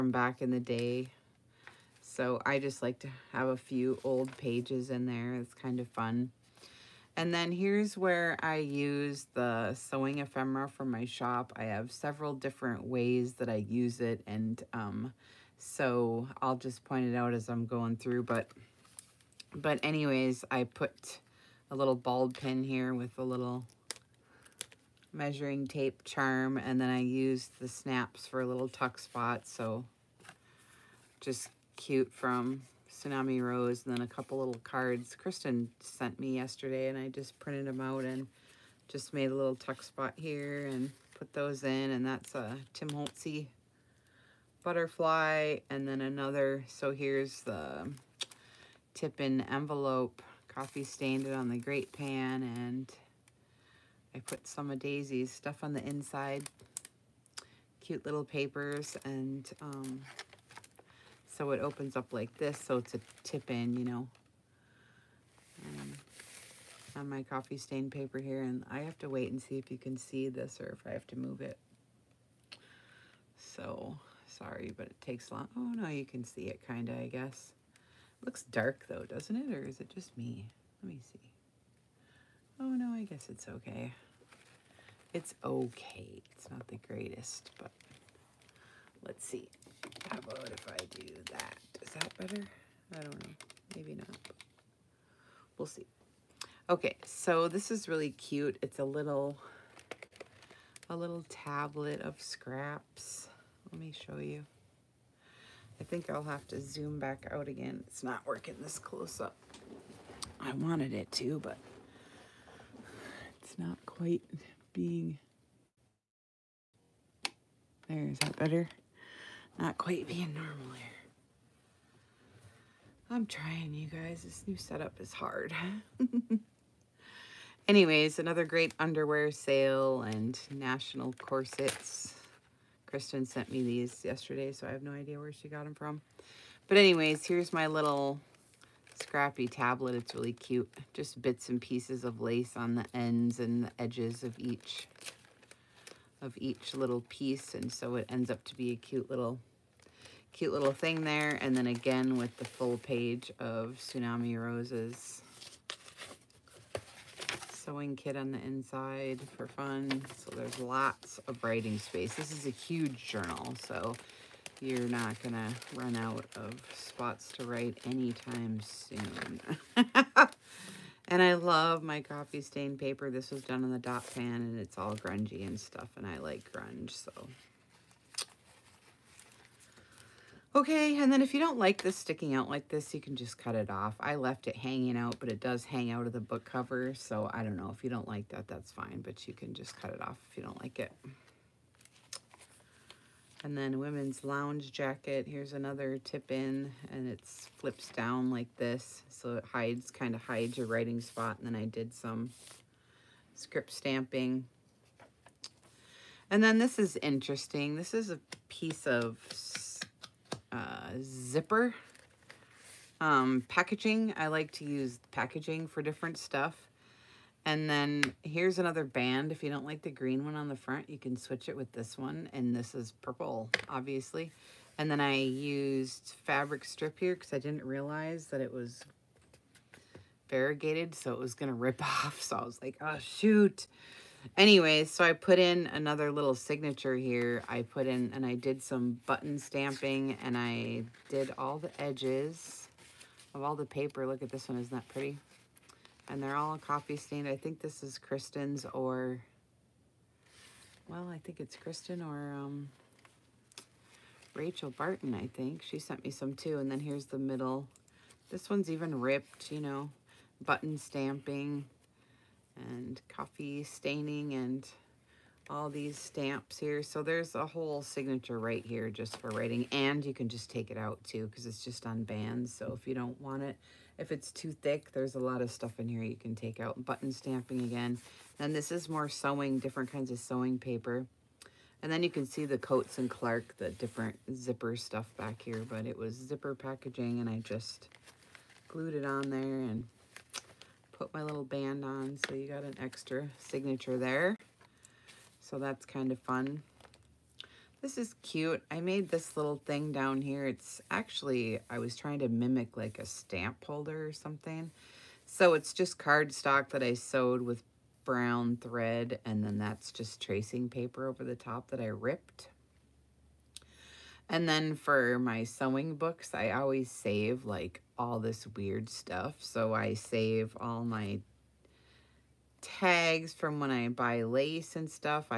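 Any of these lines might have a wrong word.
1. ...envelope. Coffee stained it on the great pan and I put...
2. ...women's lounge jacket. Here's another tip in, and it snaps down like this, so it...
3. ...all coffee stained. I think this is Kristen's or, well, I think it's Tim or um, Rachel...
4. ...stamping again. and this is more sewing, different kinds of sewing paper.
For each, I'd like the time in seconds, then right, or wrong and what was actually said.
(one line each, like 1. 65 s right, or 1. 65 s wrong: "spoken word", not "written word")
1. 49 s right
2. 193 s wrong: "flips", not "snaps"
3. 246 s wrong: "Kristen", not "Tim"
4. 277 s right.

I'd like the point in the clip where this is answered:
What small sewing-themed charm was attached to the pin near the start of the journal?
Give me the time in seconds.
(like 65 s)
25 s.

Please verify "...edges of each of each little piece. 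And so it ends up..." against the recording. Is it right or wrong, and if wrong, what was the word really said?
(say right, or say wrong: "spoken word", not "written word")
right.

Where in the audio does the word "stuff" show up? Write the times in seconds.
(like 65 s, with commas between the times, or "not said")
55 s, 175 s, 216 s, 275 s, 284 s, 318 s.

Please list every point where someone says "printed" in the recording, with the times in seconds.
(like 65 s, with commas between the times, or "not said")
37 s.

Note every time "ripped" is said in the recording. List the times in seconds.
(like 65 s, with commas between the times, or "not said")
258 s, 311 s.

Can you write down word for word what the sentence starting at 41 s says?
And that's a Tim Holtzy butterfly and then another.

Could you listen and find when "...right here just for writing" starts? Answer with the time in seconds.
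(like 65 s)
268 s.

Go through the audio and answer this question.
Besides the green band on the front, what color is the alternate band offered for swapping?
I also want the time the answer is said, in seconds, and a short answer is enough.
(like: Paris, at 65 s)
purple, at 223 s.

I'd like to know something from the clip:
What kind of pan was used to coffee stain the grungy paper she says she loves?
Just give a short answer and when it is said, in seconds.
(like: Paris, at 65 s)
dot pan, at 173 s.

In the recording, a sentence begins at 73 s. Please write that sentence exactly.
So sorry, but it takes long.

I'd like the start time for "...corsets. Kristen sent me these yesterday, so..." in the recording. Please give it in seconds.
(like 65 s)
131 s.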